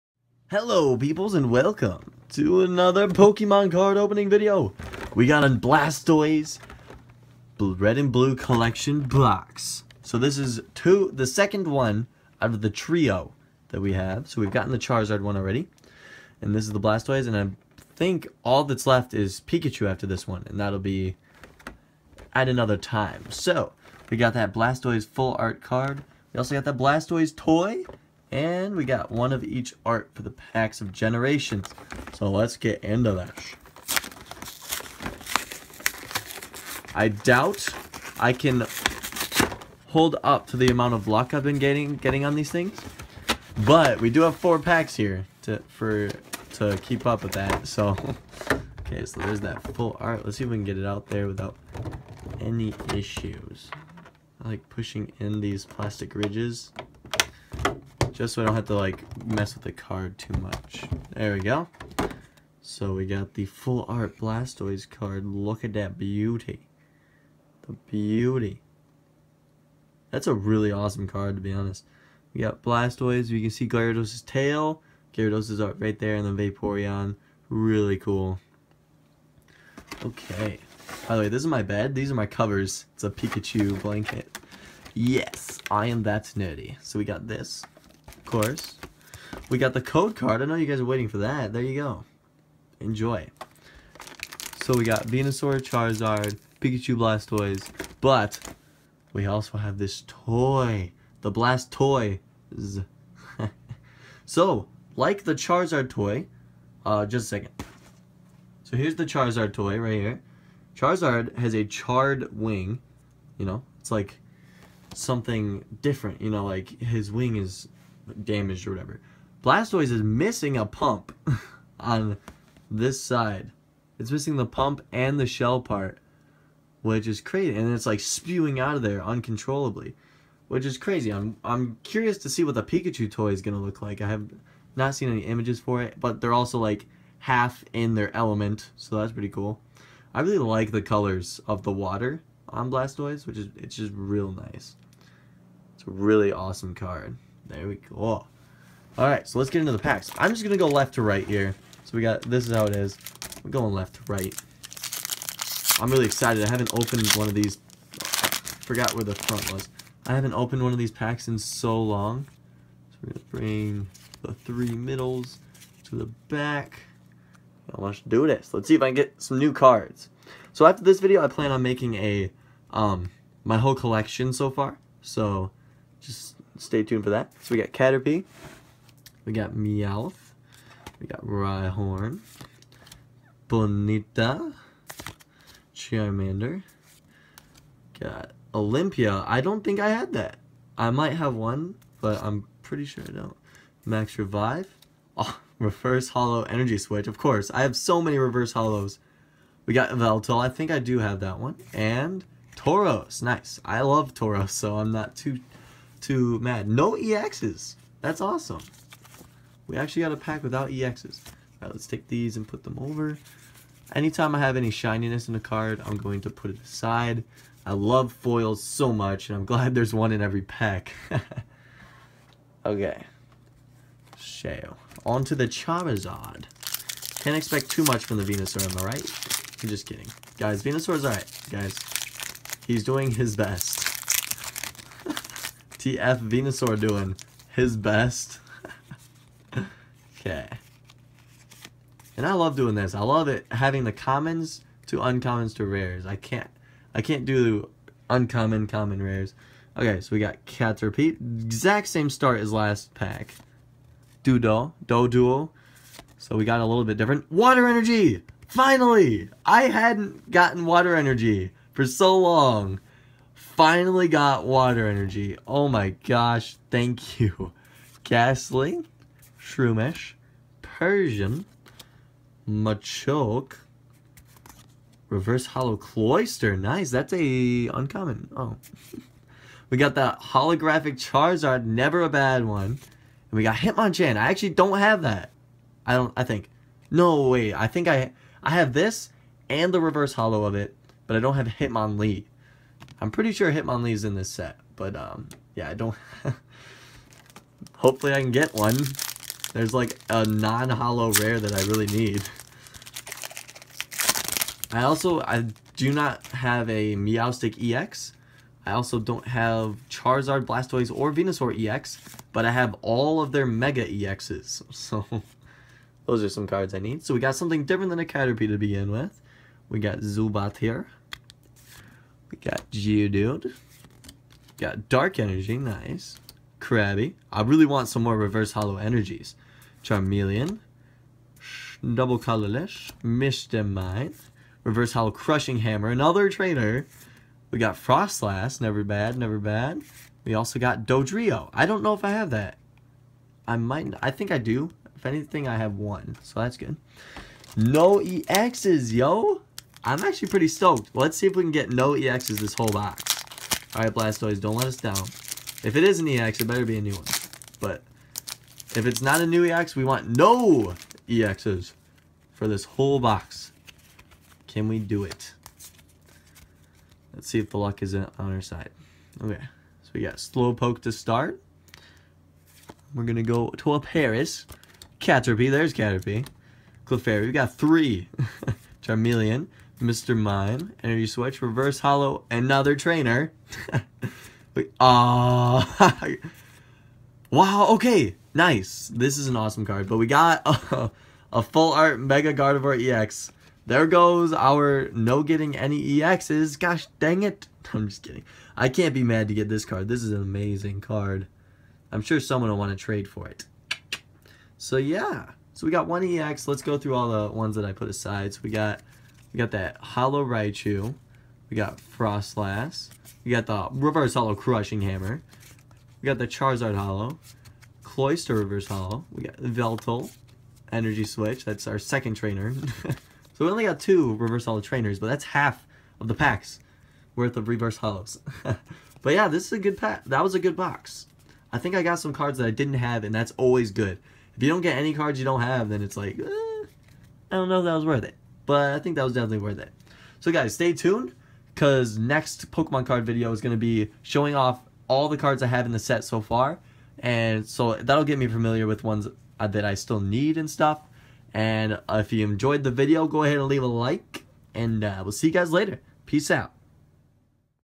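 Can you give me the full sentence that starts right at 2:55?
So, just stay tuned for that.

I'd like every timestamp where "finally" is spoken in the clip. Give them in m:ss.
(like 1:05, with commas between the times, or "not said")
4:18, 4:23.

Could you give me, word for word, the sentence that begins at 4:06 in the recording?
I can't I can't do uncommon common rares.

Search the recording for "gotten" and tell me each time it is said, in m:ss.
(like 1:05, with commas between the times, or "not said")
0:14, 4:20.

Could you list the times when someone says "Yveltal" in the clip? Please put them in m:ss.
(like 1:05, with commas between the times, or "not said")
3:19, 6:59.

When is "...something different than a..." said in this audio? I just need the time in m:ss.
5:17.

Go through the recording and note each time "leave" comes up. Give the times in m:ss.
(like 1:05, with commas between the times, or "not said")
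7:33.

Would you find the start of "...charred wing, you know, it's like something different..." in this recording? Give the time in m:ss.
1:51.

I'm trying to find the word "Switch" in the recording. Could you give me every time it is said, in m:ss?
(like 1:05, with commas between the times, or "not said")
3:16, 6:21, 7:01.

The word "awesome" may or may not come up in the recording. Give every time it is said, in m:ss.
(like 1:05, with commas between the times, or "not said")
1:10, 2:26, 3:28, 6:29.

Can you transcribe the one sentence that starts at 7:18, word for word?
But I think that was definitely worth it.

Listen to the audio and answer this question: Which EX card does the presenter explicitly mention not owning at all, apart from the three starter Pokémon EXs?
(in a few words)
Meowstic EX.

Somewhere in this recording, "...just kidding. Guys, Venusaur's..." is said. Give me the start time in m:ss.
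3:49.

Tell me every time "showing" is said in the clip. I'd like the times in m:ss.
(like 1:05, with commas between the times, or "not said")
7:24.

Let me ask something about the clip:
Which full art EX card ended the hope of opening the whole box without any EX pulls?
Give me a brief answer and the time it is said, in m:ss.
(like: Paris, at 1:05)
Mega Gardevoir EX, at 6:31.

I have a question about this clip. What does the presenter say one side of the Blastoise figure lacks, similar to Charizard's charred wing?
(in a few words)
A pump.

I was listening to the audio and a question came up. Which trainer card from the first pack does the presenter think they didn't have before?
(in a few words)
Olympia.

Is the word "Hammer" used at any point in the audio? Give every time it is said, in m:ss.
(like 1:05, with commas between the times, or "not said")
5:35, 6:54.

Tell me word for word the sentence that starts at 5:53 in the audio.
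Alright, Blastoise, don't let us down.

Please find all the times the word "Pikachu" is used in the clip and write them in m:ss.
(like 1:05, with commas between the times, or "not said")
0:19, 1:23, 1:36, 2:12.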